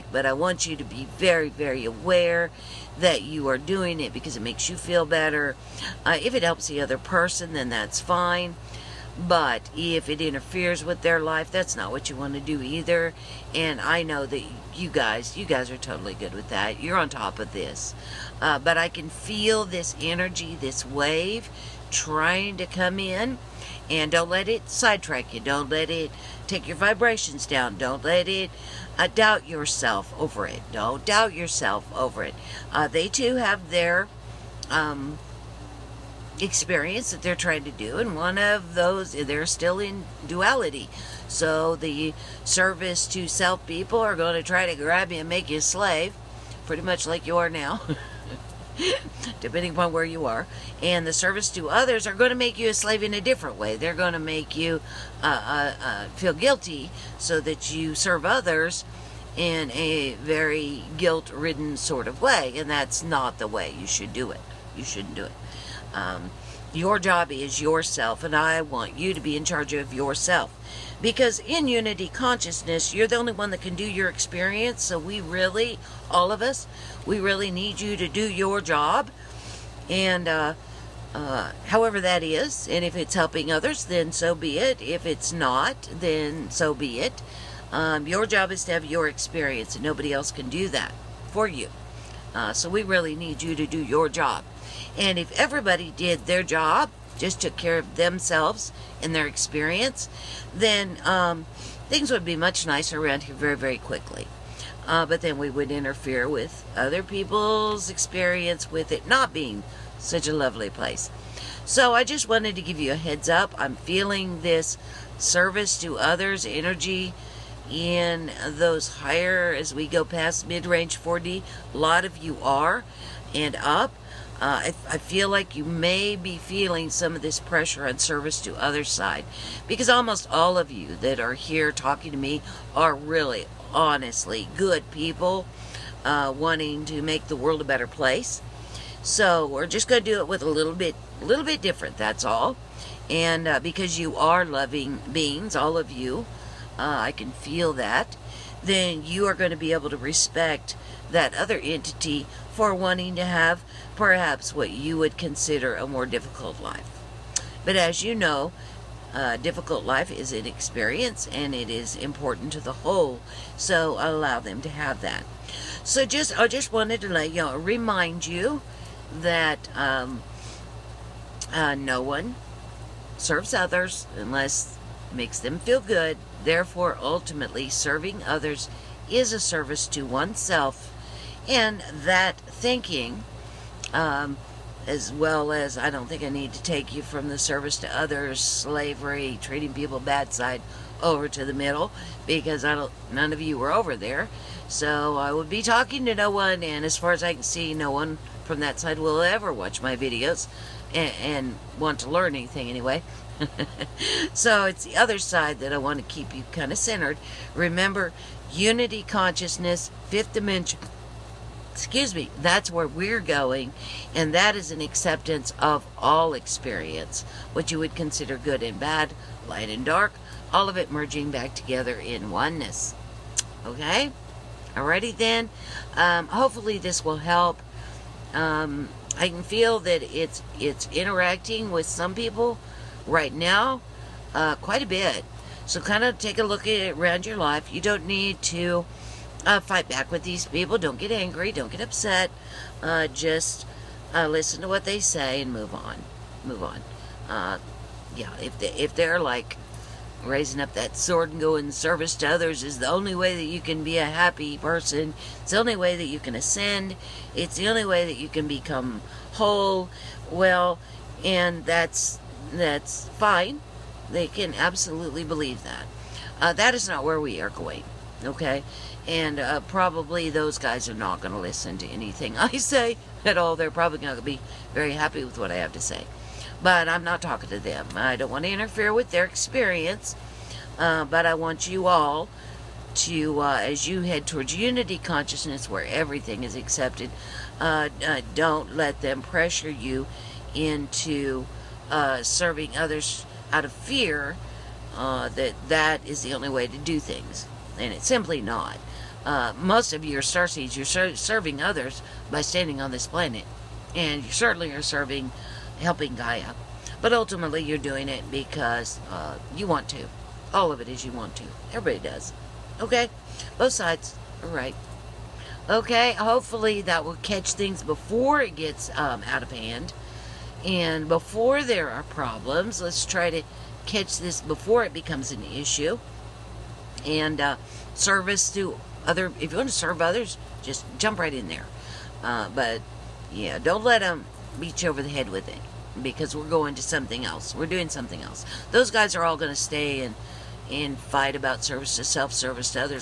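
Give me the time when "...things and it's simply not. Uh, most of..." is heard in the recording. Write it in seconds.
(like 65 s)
296 s.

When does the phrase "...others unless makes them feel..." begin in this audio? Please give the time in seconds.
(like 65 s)
173 s.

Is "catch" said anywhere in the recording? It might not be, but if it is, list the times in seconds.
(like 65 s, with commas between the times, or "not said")
317 s, 323 s.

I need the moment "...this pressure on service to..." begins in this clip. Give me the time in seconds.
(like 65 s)
127 s.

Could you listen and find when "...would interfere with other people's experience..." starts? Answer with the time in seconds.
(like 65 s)
105 s.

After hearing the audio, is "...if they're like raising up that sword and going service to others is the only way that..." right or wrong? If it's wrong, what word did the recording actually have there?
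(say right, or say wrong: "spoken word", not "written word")
right.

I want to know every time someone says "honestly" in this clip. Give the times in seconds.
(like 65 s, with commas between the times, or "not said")
133 s.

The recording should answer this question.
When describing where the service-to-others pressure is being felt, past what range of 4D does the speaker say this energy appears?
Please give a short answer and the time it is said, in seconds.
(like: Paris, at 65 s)
mid range 4D, at 120 s.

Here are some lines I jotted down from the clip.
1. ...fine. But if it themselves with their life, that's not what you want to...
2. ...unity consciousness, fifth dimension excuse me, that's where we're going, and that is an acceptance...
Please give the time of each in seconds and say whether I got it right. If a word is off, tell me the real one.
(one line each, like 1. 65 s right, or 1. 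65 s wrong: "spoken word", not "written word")
1. 8 s wrong: "interferes", not "themselves"
2. 208 s right.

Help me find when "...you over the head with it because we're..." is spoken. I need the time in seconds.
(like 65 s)
334 s.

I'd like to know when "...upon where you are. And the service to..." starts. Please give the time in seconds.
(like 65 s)
49 s.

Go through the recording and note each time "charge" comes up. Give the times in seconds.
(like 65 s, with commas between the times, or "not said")
69 s.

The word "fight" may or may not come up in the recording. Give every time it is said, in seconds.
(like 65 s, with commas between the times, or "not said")
239 s, 340 s.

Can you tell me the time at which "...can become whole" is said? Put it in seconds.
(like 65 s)
258 s.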